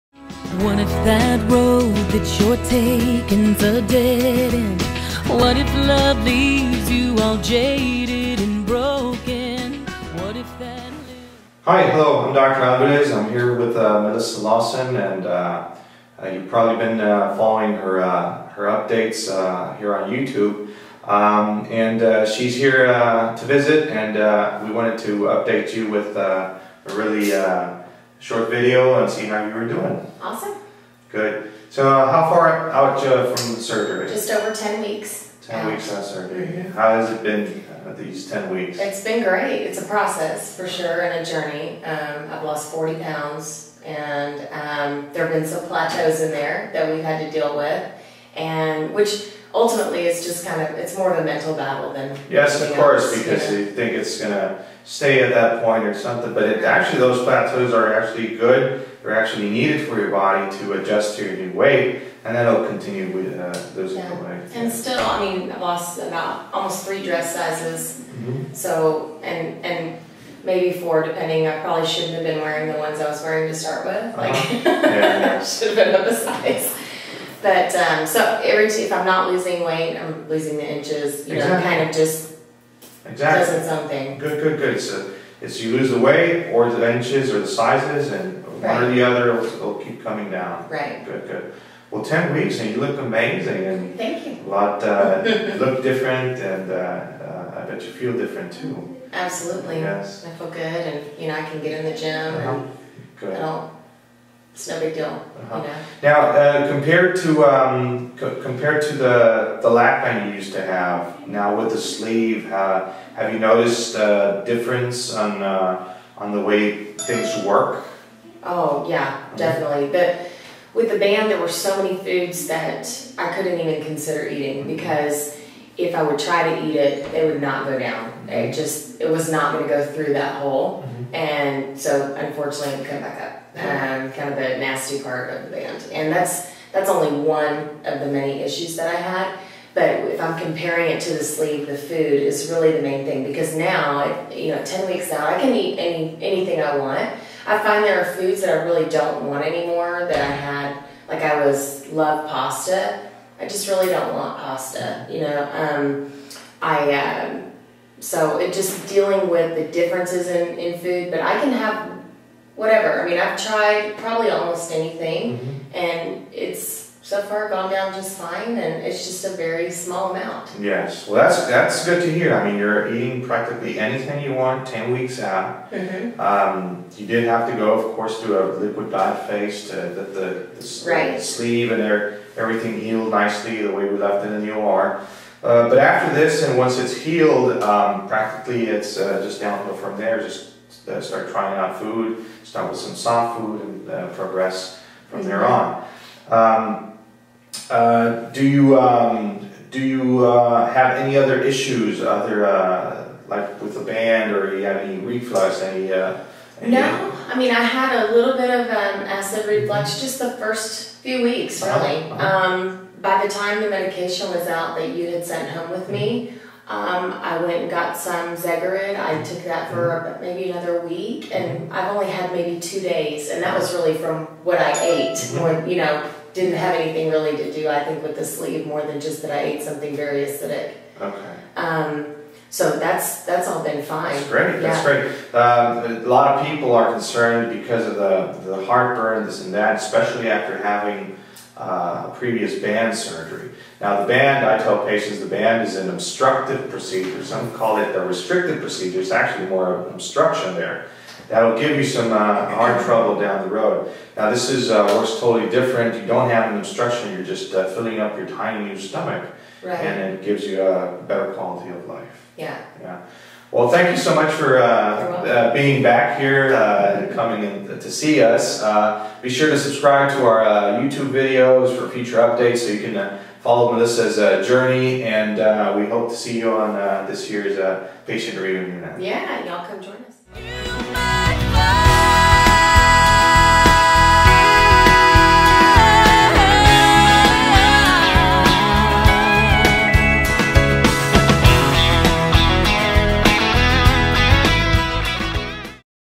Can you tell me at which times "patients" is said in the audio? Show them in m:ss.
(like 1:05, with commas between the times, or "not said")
4:04, 4:38.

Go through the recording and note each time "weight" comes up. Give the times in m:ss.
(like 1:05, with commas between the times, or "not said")
1:01, 1:19, 1:25.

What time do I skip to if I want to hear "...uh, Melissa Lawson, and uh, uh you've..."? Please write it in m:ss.
0:13.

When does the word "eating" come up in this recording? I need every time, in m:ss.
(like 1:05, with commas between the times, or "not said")
2:04, 2:52.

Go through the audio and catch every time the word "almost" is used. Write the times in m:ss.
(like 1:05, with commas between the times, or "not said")
1:06, 2:44.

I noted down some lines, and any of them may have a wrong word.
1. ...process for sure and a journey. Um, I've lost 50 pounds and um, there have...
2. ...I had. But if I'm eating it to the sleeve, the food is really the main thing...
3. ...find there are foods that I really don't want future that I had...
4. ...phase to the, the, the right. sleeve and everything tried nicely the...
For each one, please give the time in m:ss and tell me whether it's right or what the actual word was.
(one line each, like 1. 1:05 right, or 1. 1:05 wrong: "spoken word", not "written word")
1. 0:39 wrong: "40", not "50"
2. 2:18 wrong: "comparing", not "eating"
3. 2:27 wrong: "anymore", not "future"
4. 2:59 wrong: "healed", not "tried".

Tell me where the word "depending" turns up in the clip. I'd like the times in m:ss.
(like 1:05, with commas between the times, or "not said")
1:11.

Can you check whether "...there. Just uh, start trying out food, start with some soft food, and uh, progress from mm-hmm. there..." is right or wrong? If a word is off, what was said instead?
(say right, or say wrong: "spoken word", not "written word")
right.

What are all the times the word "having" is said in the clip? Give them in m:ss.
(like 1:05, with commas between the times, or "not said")
4:00.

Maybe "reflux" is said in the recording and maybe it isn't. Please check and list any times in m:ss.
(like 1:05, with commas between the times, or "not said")
3:24, 3:29.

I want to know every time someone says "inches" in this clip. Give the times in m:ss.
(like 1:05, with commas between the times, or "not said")
1:20, 1:26.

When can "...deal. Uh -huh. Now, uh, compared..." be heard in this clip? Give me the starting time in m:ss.
1:44.